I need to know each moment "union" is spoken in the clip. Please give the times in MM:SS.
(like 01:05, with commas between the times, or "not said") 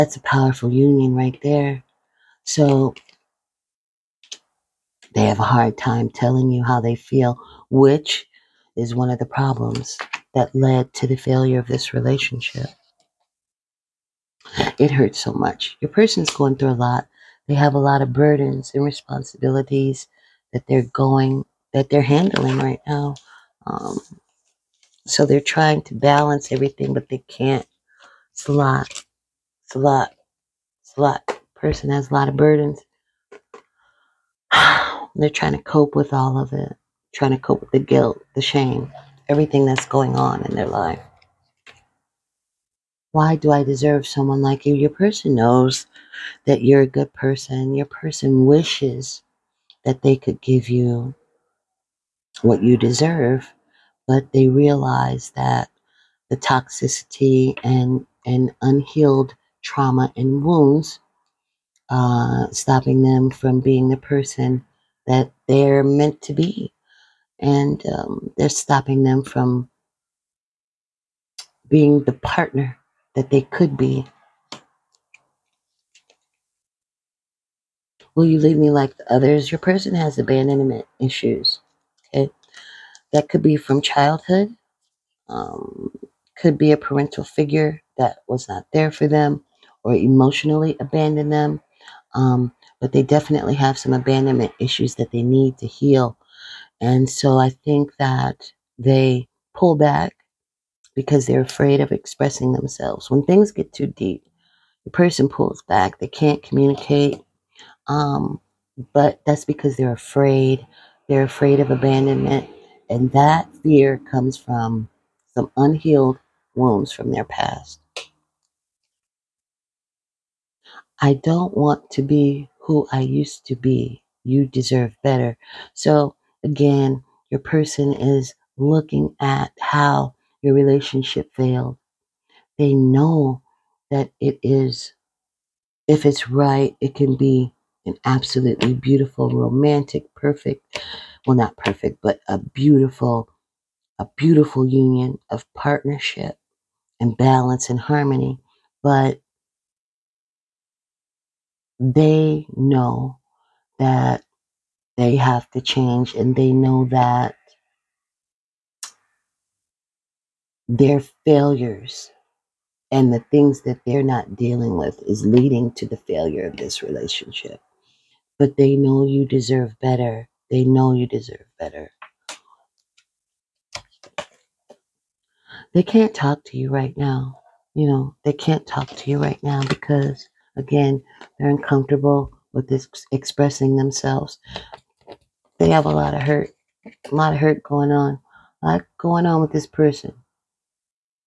00:00, 02:24.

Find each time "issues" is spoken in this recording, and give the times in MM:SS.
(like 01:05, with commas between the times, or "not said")
01:20, 01:34.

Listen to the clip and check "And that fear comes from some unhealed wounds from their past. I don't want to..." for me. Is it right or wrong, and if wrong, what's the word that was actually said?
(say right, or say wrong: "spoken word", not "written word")
right.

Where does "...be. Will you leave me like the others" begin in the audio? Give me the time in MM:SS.
01:13.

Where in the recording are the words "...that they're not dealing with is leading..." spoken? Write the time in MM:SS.
02:43.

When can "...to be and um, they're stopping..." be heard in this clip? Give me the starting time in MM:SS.
01:06.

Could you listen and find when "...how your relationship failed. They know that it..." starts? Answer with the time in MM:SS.
02:09.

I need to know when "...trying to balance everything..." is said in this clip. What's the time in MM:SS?
00:25.